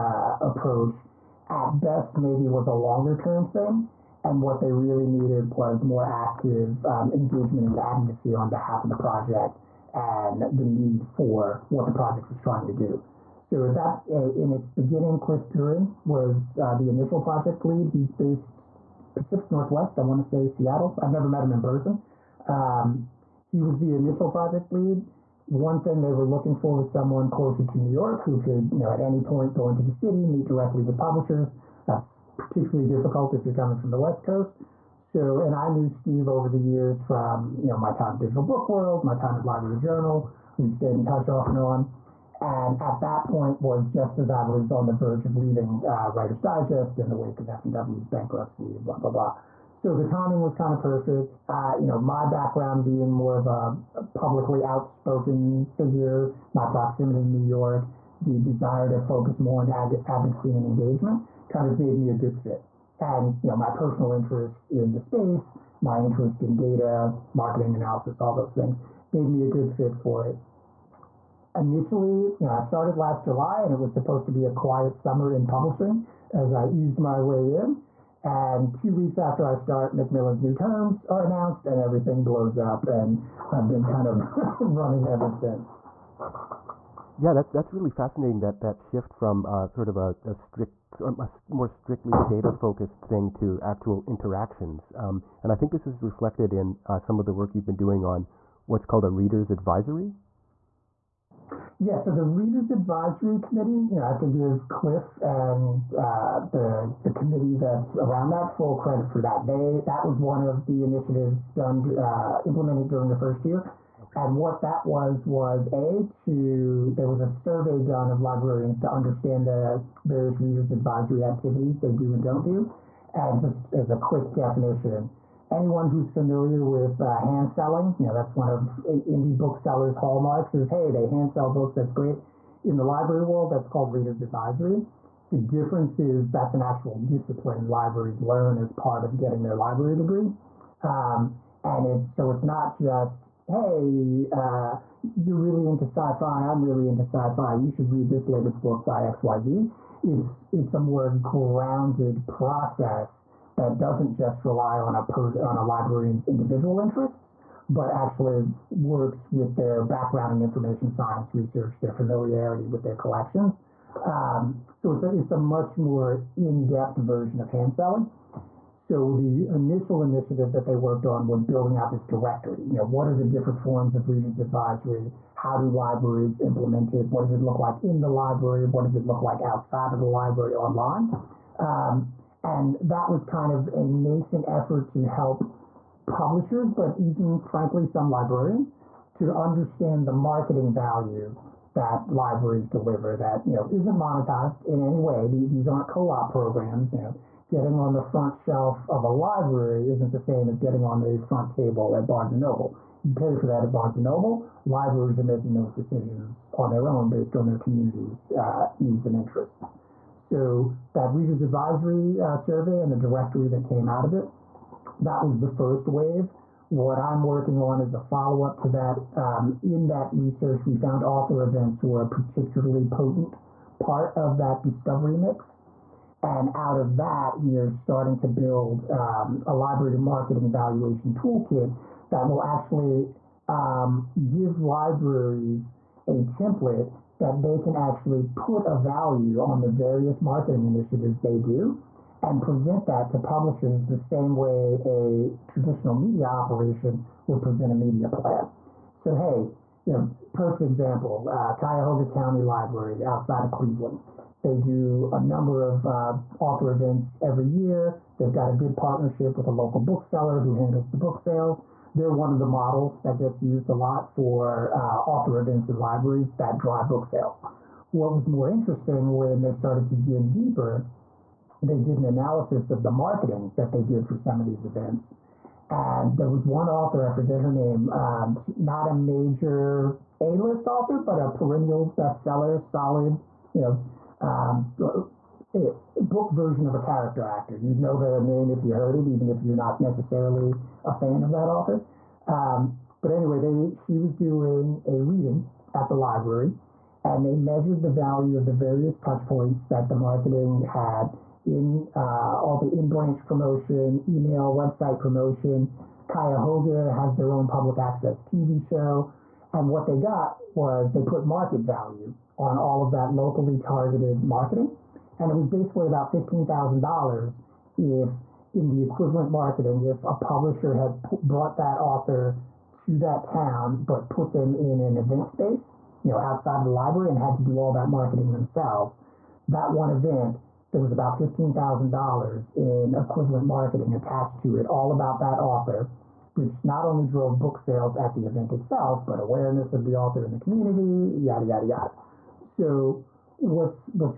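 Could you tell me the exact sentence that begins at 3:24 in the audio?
Libraries are making those decisions on their own based on their community's uh, needs and interests.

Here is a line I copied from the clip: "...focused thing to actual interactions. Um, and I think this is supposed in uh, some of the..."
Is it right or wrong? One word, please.
wrong.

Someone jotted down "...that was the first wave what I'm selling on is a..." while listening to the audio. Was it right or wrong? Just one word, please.
wrong.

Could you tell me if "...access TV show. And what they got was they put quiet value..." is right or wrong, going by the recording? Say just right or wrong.
wrong.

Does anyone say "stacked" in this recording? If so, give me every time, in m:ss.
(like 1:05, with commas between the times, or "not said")
not said.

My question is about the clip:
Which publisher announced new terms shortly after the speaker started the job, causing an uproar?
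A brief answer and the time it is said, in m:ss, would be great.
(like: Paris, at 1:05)
Macmillan, at 1:19.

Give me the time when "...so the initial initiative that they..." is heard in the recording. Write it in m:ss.
2:48.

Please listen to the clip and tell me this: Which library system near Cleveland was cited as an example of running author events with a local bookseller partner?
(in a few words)
Cuyahoga County Library.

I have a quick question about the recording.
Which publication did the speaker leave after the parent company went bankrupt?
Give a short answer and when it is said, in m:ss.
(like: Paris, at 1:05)
Writer's Digest, at 0:46.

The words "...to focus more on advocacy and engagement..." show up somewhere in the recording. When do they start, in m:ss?
0:58.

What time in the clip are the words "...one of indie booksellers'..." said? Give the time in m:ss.
2:08.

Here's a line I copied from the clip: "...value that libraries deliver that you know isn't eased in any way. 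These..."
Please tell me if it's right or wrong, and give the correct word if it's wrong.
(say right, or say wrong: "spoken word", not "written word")
wrong: "monetized", not "eased".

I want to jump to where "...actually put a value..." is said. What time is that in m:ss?
3:57.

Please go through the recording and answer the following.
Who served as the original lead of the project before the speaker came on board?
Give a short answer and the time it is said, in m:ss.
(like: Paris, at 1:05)
Cliff Guren, at 0:15.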